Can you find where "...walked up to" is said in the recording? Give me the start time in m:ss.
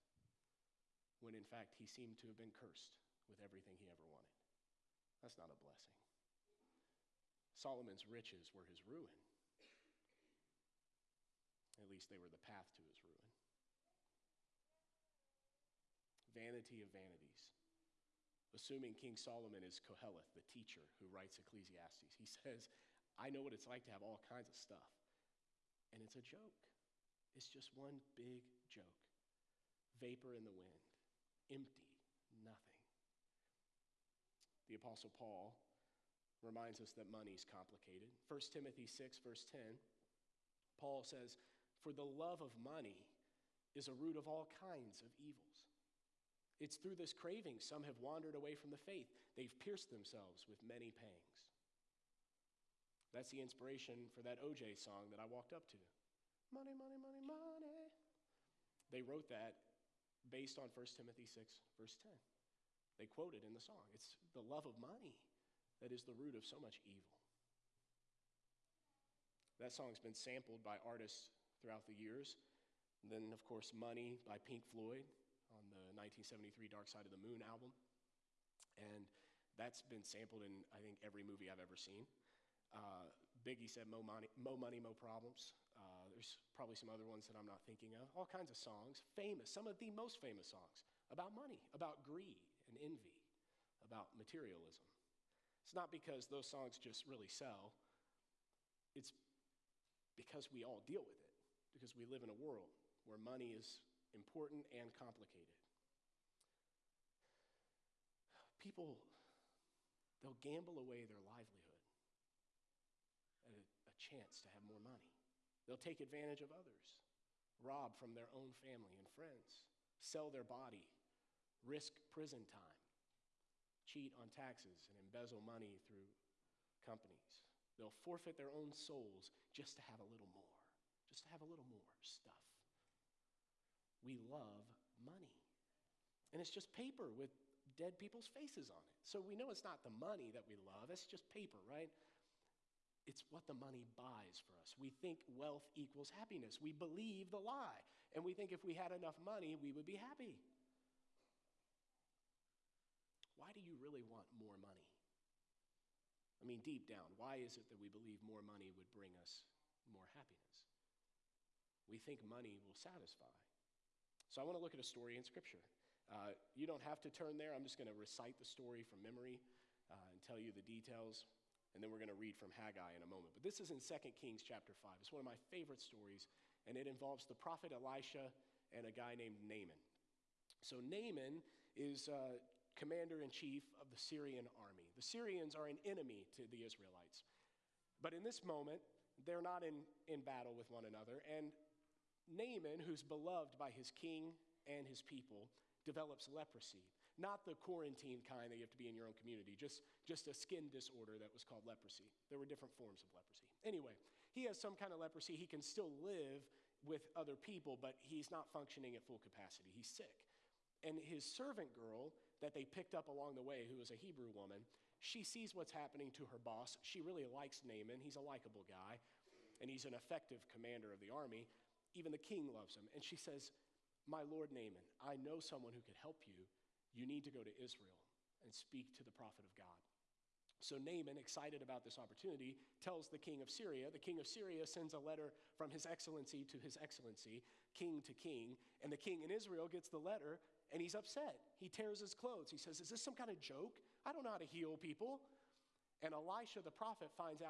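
0:55.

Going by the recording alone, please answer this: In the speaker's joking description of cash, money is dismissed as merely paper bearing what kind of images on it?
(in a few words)
dead people's faces.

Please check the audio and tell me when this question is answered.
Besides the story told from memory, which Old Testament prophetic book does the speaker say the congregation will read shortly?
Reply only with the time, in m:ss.
2:52.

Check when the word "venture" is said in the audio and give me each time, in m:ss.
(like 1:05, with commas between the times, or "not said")
not said.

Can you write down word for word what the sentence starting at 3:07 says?
But in this moment, they're not in, in battle with one another.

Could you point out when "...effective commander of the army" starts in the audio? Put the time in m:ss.
3:39.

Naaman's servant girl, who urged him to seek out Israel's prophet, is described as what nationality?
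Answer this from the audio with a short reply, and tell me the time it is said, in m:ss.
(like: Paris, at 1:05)
Hebrew, at 3:33.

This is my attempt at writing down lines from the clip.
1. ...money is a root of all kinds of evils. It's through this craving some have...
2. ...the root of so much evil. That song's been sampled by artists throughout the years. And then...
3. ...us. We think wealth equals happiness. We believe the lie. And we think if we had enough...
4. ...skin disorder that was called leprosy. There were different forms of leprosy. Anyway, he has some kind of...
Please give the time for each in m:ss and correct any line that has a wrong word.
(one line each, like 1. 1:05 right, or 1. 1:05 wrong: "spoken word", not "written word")
1. 0:42 right
2. 1:06 right
3. 2:24 right
4. 3:20 right.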